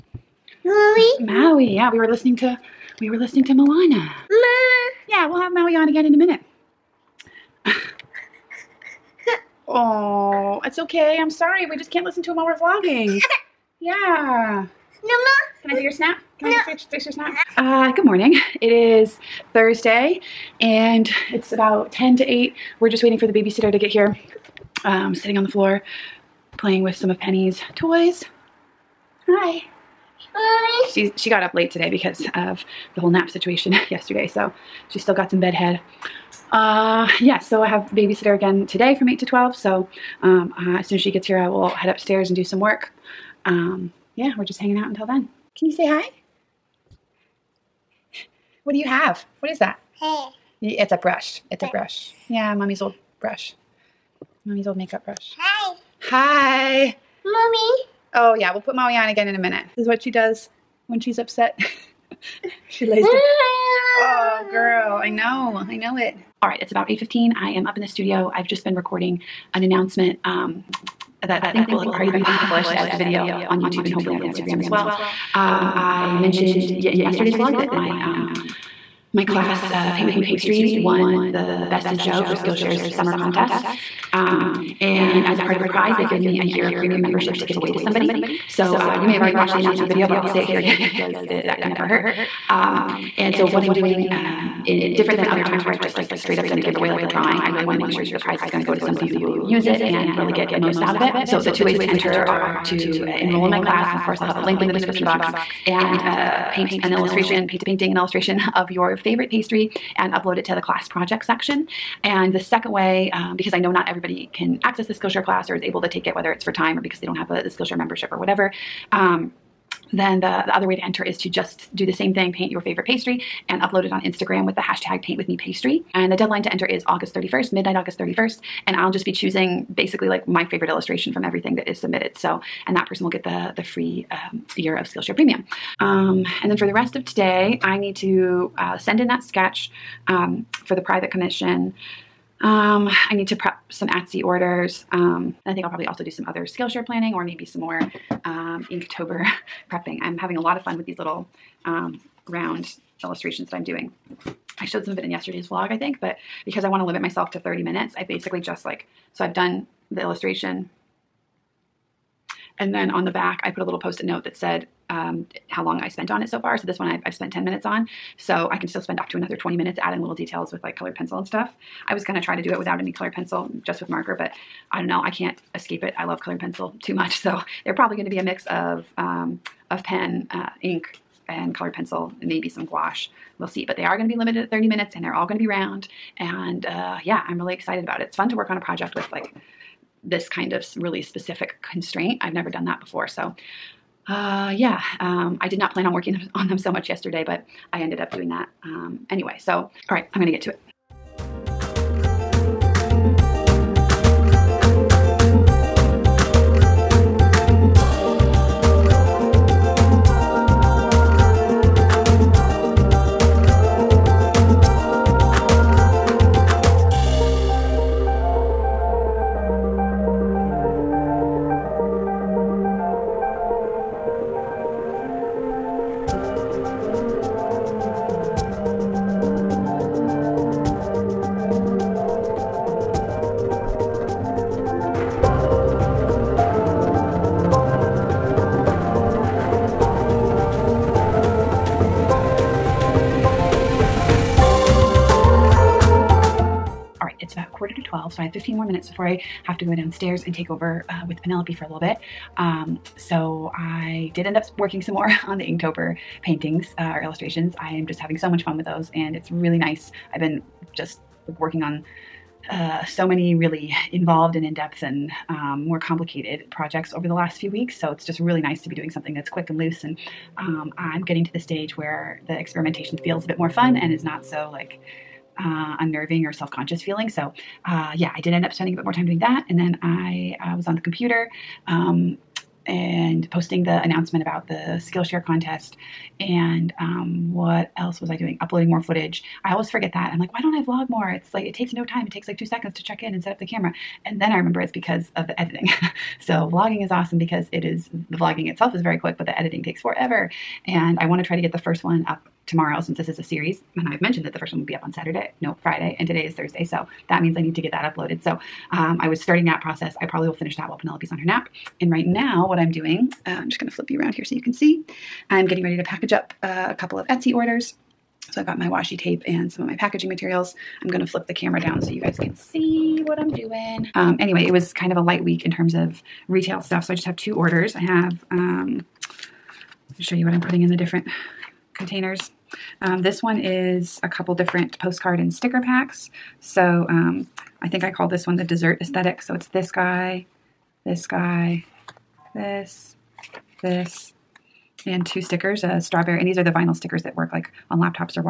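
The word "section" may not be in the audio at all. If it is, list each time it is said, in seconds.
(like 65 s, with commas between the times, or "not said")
111 s.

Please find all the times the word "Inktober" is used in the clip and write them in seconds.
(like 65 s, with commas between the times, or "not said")
148 s, 255 s.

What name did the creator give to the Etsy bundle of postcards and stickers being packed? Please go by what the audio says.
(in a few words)
the dessert aesthetic.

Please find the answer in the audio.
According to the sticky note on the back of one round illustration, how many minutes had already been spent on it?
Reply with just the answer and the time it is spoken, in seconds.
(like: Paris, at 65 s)
10, at 167 s.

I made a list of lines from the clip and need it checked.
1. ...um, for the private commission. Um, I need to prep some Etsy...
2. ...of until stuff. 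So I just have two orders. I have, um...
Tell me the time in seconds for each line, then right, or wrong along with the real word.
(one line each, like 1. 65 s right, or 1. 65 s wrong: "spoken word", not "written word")
1. 140 s right
2. 325 s wrong: "retail", not "until".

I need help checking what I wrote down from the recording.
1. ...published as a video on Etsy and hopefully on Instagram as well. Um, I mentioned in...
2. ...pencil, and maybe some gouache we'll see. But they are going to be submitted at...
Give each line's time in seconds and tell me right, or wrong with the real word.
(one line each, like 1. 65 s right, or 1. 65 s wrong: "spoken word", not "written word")
1. 72 s wrong: "YouTube", not "Etsy"
2. 181 s wrong: "limited", not "submitted".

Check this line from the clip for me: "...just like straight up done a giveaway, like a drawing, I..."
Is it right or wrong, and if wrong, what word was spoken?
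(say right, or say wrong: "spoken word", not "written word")
right.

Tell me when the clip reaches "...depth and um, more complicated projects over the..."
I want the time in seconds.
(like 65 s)
264 s.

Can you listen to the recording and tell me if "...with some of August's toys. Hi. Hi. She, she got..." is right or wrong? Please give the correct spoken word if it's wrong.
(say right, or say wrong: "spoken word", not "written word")
wrong: "Penny", not "August".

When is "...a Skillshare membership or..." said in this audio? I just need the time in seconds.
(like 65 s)
117 s.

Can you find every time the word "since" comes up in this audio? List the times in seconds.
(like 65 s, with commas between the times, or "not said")
302 s.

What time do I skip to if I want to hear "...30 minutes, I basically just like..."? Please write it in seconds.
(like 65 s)
157 s.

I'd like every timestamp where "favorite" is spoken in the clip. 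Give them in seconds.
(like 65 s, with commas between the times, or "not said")
108 s, 122 s, 130 s.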